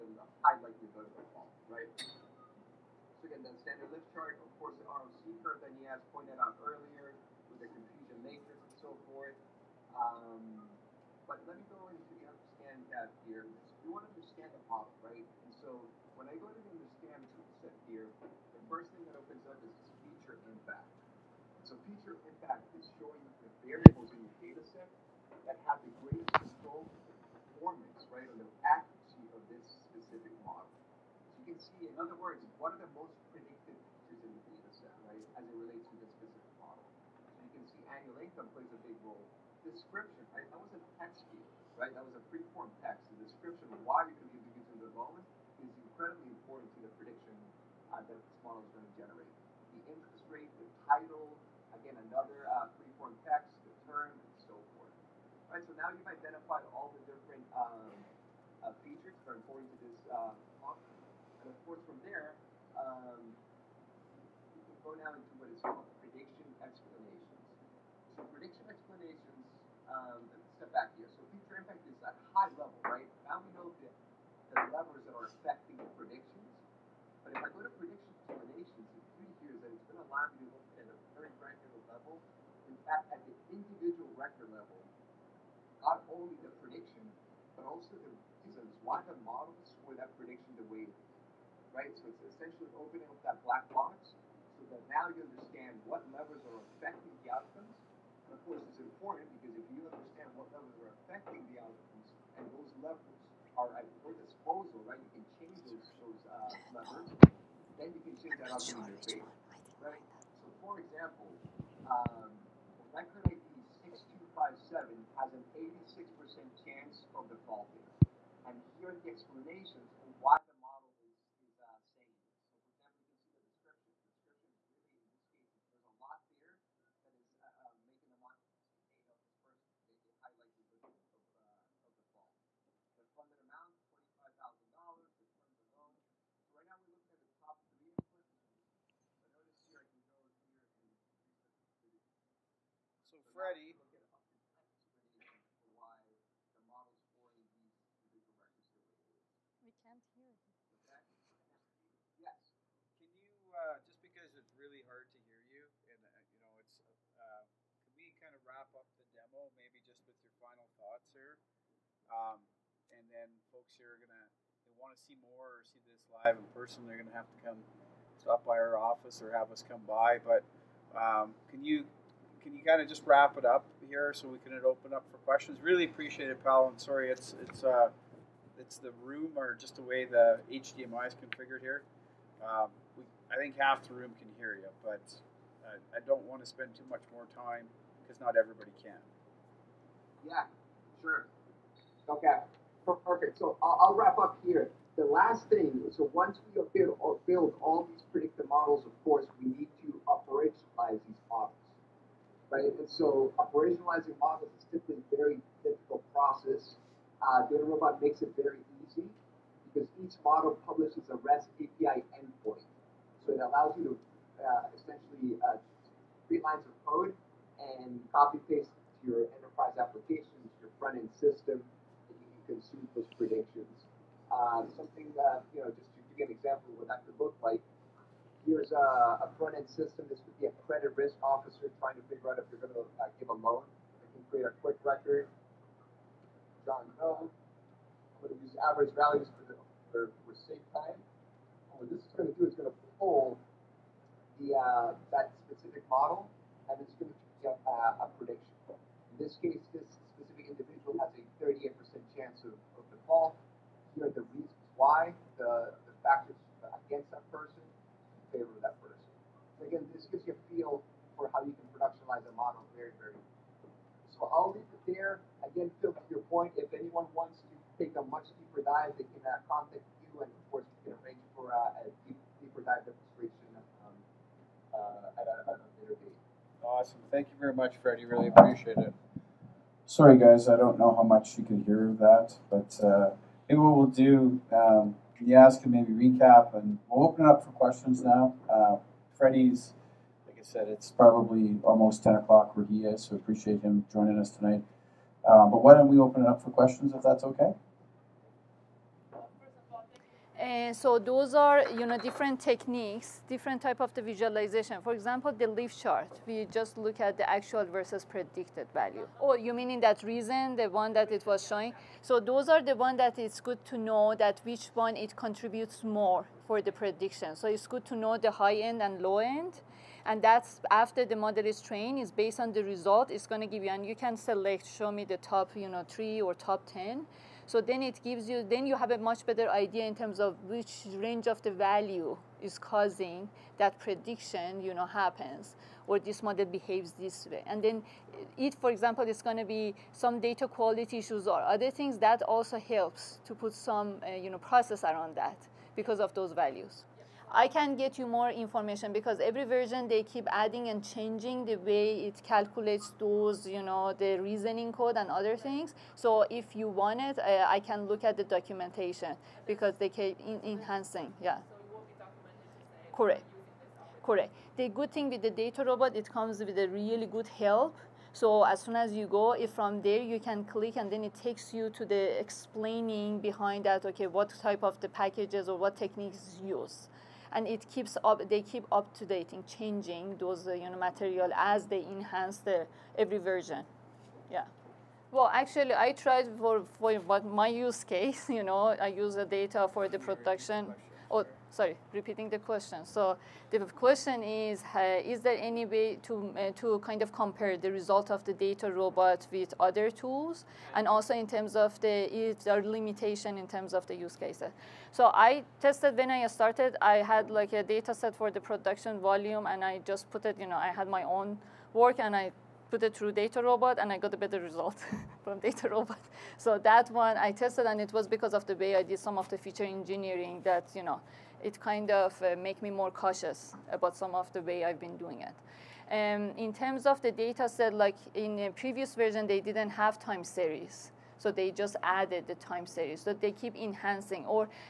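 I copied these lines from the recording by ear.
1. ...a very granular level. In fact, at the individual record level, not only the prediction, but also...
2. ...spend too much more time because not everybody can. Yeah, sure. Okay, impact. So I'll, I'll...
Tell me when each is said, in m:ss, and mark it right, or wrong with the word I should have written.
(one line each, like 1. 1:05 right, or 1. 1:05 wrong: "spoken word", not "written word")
1. 1:20 right
2. 3:06 wrong: "perfect", not "impact".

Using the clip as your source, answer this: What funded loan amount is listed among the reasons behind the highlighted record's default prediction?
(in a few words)
$25,000.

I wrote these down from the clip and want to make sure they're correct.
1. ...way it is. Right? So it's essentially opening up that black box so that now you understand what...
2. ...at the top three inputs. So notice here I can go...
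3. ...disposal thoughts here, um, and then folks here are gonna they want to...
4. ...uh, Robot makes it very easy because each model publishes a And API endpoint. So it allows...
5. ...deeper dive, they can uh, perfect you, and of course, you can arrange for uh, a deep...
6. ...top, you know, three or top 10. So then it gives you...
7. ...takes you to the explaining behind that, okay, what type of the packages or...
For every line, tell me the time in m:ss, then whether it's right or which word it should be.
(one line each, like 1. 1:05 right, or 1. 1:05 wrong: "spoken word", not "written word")
1. 1:30 right
2. 2:17 right
3. 2:40 wrong: "final", not "disposal"
4. 3:27 wrong: "REST", not "And"
5. 4:28 wrong: "contact", not "perfect"
6. 5:25 right
7. 6:11 right.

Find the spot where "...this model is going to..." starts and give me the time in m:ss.
0:48.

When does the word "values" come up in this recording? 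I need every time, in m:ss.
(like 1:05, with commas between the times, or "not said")
3:58, 5:08, 5:31, 5:46.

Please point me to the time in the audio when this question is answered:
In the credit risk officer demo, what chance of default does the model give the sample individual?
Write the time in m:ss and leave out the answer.
4:11.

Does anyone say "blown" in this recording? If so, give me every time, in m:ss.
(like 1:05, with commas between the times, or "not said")
not said.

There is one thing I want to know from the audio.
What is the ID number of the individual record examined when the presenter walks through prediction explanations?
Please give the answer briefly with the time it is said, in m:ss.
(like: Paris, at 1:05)
6257, at 1:53.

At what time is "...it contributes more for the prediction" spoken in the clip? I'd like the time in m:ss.
5:14.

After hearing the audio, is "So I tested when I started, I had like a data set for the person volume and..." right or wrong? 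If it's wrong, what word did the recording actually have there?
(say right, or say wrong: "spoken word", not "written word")
wrong: "production", not "person".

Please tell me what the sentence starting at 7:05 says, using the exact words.
Um, in terms of the data set, like in the previous version, they didn't have time series.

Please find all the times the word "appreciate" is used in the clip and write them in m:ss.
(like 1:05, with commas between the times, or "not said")
2:55, 4:38, 4:53.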